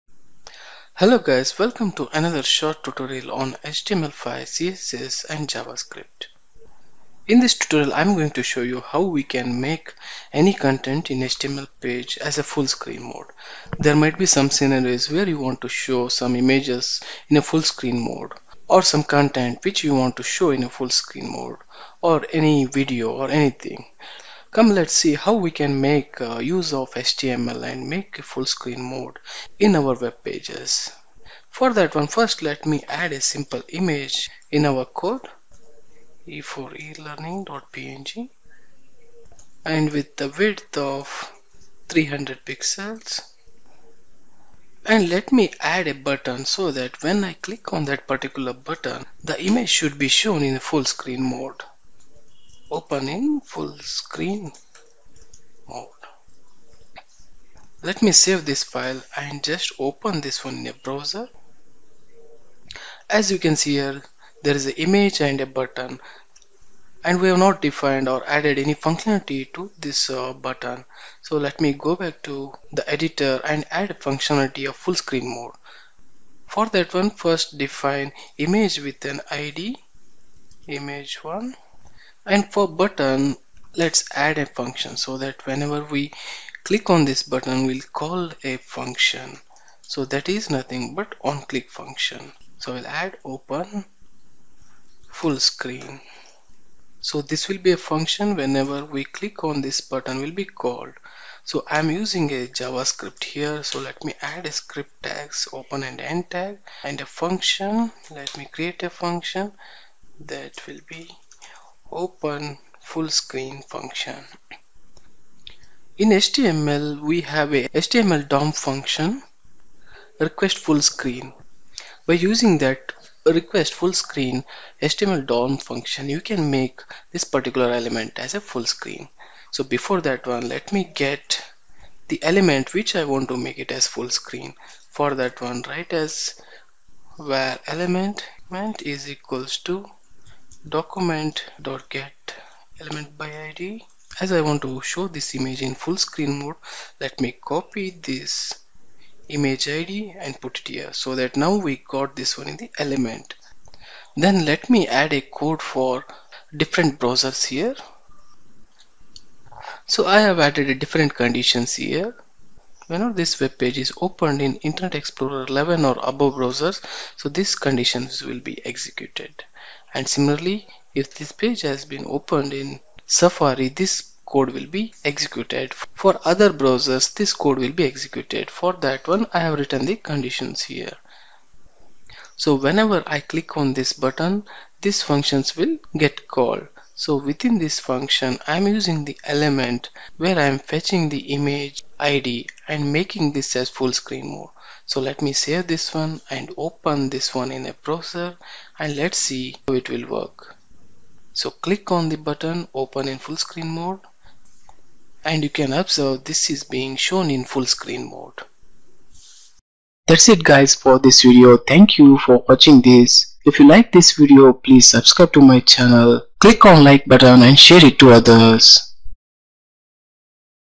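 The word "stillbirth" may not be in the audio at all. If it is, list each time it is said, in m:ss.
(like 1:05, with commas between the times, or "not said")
not said.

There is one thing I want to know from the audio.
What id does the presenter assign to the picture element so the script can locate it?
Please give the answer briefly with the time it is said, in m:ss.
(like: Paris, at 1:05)
image1, at 1:20.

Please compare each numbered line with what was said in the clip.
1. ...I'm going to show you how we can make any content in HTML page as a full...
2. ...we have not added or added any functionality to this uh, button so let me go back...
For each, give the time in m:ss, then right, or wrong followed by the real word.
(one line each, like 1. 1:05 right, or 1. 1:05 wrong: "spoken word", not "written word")
1. 0:07 right
2. 1:07 wrong: "defined", not "added".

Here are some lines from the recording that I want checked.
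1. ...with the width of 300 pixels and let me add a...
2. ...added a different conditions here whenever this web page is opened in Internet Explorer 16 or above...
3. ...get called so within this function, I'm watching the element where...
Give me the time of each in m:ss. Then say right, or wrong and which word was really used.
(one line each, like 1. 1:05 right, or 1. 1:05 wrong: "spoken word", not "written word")
1. 0:39 right
2. 2:40 wrong: "11", not "16"
3. 3:05 wrong: "using", not "watching".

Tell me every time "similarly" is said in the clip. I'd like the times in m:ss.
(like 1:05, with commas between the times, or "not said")
2:50.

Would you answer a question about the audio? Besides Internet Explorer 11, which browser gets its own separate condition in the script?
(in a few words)
Safari.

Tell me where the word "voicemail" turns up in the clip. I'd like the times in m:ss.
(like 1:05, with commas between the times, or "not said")
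not said.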